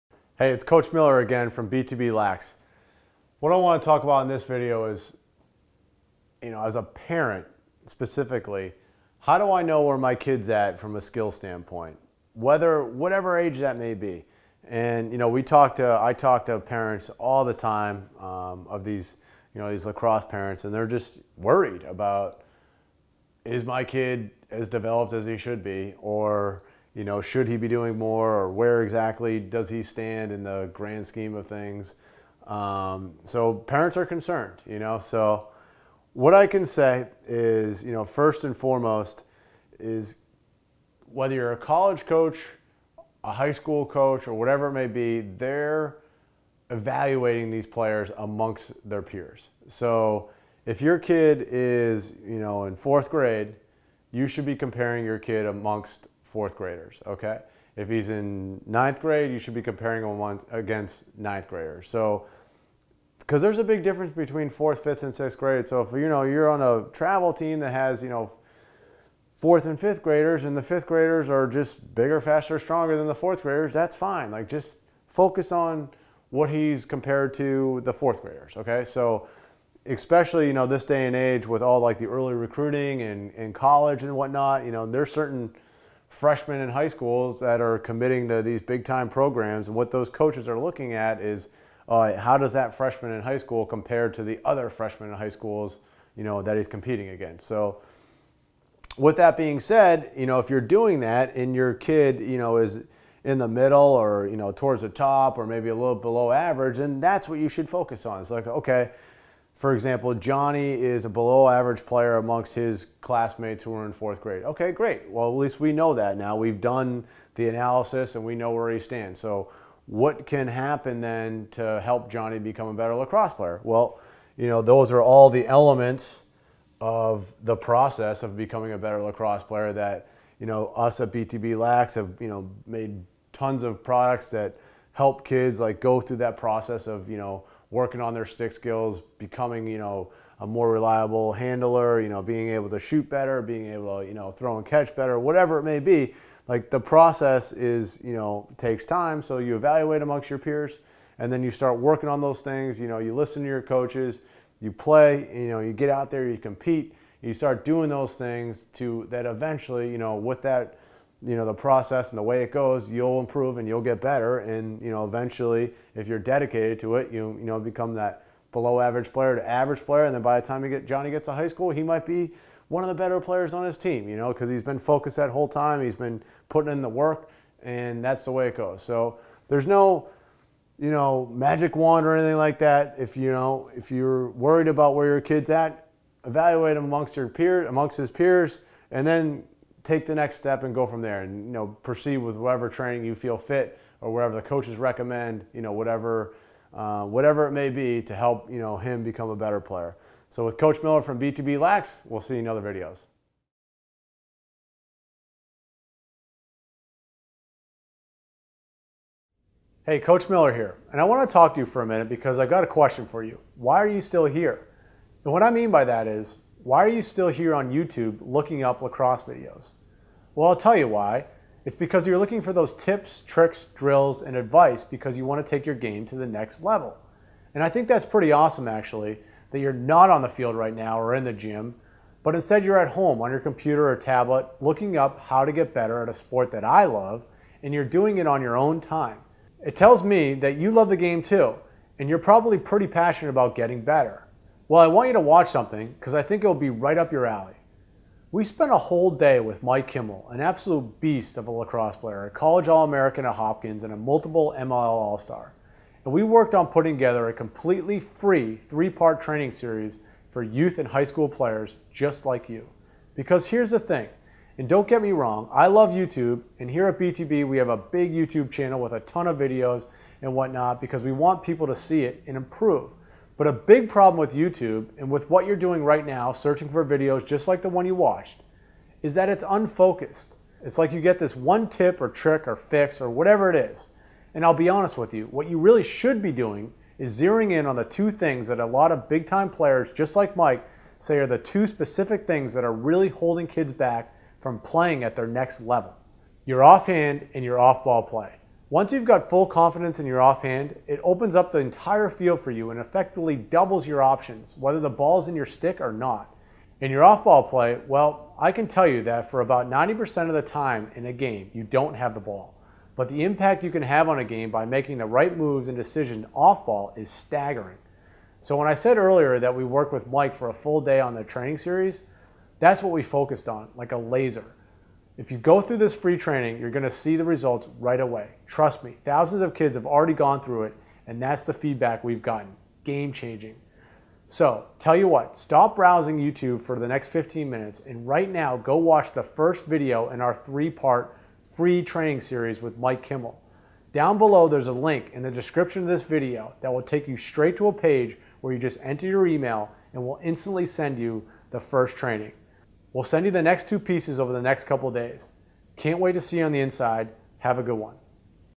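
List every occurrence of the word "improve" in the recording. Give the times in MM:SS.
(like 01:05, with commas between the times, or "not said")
02:43, 04:32.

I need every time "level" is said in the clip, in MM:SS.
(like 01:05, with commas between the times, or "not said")
03:46, 04:55.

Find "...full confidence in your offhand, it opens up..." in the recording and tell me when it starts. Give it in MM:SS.
04:59.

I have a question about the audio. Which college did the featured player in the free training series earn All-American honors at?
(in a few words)
Hopkins.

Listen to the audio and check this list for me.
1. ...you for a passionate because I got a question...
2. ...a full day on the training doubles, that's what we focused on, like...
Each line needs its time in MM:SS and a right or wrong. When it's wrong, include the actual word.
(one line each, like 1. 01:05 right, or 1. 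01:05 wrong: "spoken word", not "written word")
1. 03:31 wrong: "minute", not "passionate"
2. 05:20 wrong: "series", not "doubles".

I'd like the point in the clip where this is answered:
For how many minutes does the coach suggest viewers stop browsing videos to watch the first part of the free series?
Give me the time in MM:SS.
05:37.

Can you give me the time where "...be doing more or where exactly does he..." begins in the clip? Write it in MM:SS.
00:27.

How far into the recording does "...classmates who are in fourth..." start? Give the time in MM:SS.
01:52.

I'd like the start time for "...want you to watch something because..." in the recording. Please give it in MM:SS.
04:04.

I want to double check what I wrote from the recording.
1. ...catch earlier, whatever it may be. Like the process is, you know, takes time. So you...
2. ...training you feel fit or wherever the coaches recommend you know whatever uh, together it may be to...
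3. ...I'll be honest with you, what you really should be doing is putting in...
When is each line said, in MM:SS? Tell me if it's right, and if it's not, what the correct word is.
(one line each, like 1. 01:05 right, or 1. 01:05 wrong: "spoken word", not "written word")
1. 02:24 wrong: "better", not "earlier"
2. 03:12 wrong: "whatever", not "together"
3. 04:44 wrong: "zeroing", not "putting".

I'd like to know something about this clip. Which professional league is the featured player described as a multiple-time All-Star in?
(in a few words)
MLL.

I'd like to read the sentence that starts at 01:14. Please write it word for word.
Like just focus on what he's compared to the fourth graders.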